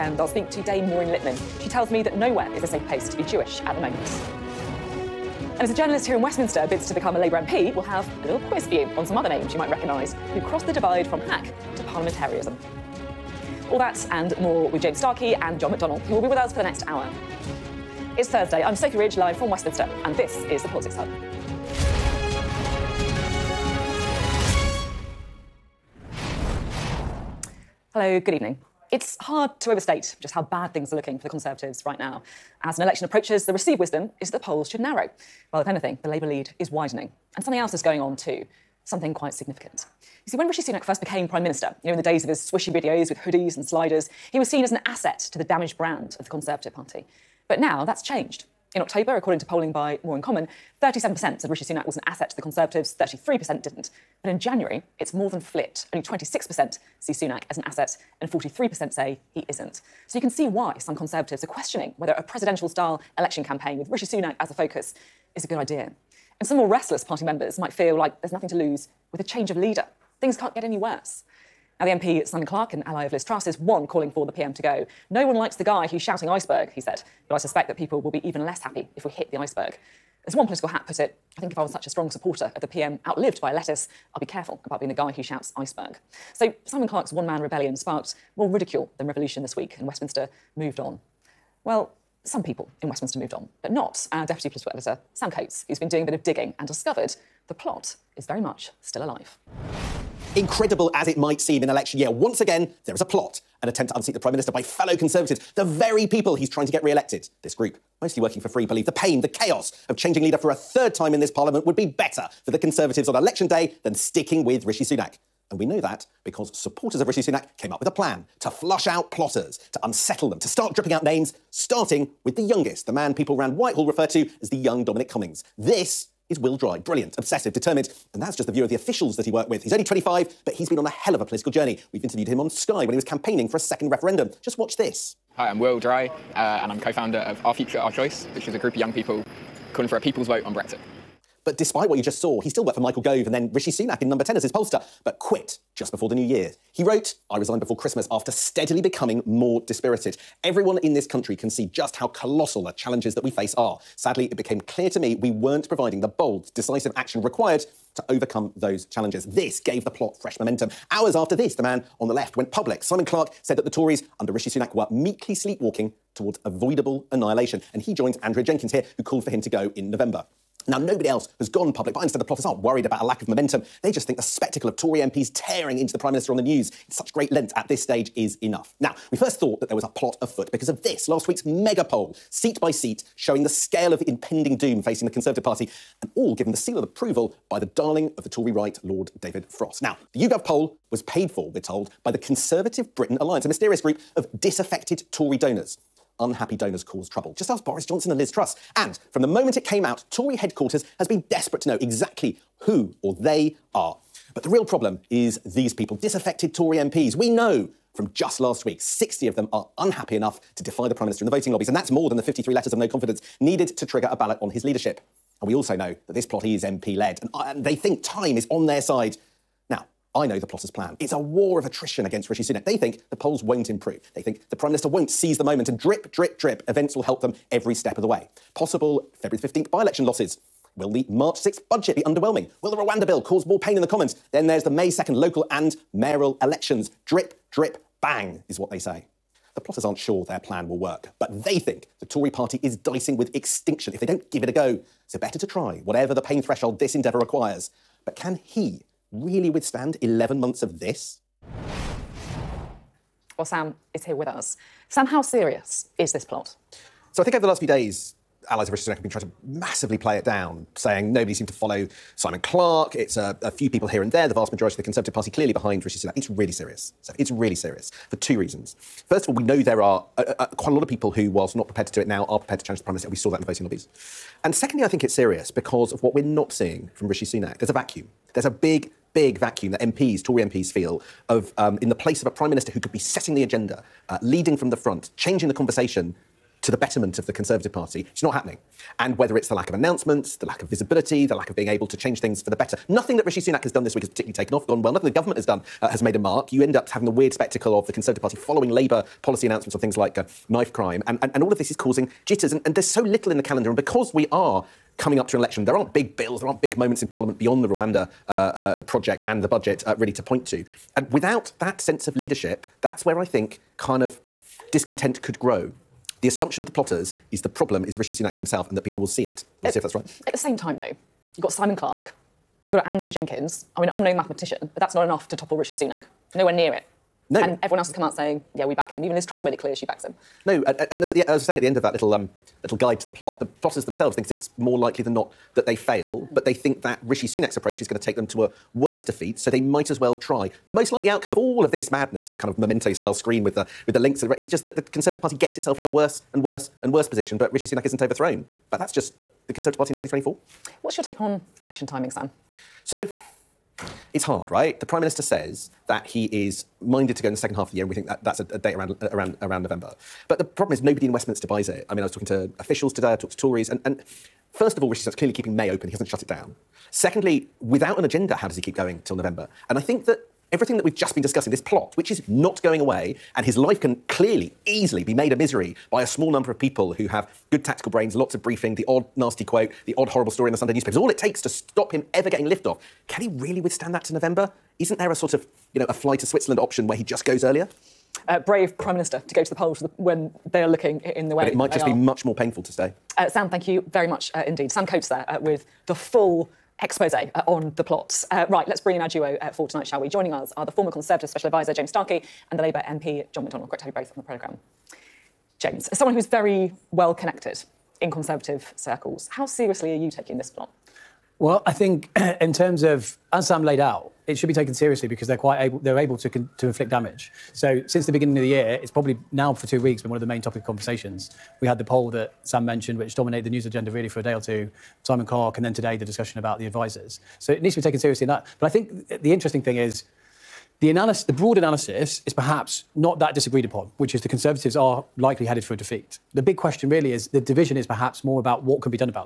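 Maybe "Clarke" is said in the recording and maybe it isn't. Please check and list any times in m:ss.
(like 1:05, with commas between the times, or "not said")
1:12, 1:26, 2:43, 4:22, 5:21, 7:05.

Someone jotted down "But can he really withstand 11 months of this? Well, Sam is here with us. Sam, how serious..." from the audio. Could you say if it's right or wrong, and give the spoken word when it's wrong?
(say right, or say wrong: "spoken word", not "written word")
right.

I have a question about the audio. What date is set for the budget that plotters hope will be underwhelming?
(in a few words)
March 6th.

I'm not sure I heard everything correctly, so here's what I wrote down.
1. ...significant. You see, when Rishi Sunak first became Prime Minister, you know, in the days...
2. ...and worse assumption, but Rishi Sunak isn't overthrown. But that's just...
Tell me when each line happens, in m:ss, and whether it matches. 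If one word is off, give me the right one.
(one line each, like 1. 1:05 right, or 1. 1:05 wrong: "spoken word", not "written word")
1. 0:39 right
2. 5:46 wrong: "position", not "assumption".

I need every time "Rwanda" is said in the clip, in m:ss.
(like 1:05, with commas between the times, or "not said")
3:52, 5:07.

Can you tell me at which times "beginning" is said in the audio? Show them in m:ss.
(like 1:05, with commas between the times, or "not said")
6:58.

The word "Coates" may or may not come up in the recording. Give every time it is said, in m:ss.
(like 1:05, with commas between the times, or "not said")
1:35, 6:34.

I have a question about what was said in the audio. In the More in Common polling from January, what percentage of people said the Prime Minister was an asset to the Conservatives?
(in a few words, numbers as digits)
26%.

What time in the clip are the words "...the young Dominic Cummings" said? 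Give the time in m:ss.
2:04.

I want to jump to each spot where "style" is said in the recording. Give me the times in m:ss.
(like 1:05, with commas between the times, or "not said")
1:02, 5:42.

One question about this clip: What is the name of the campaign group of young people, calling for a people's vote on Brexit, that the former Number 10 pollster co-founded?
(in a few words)
Our Future, Our Choice.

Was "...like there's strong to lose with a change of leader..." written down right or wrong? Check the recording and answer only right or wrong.
wrong.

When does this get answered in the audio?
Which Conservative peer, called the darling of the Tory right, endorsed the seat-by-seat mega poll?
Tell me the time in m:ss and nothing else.
3:08.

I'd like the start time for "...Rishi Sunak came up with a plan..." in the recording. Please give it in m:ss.
1:57.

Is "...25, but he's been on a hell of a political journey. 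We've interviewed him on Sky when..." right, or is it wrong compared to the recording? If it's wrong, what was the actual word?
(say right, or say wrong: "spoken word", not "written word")
right.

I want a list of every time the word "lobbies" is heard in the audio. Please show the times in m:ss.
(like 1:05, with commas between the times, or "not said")
3:31, 4:33.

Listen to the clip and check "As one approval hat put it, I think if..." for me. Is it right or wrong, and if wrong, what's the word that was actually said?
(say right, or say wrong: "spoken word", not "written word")
wrong: "political", not "approval".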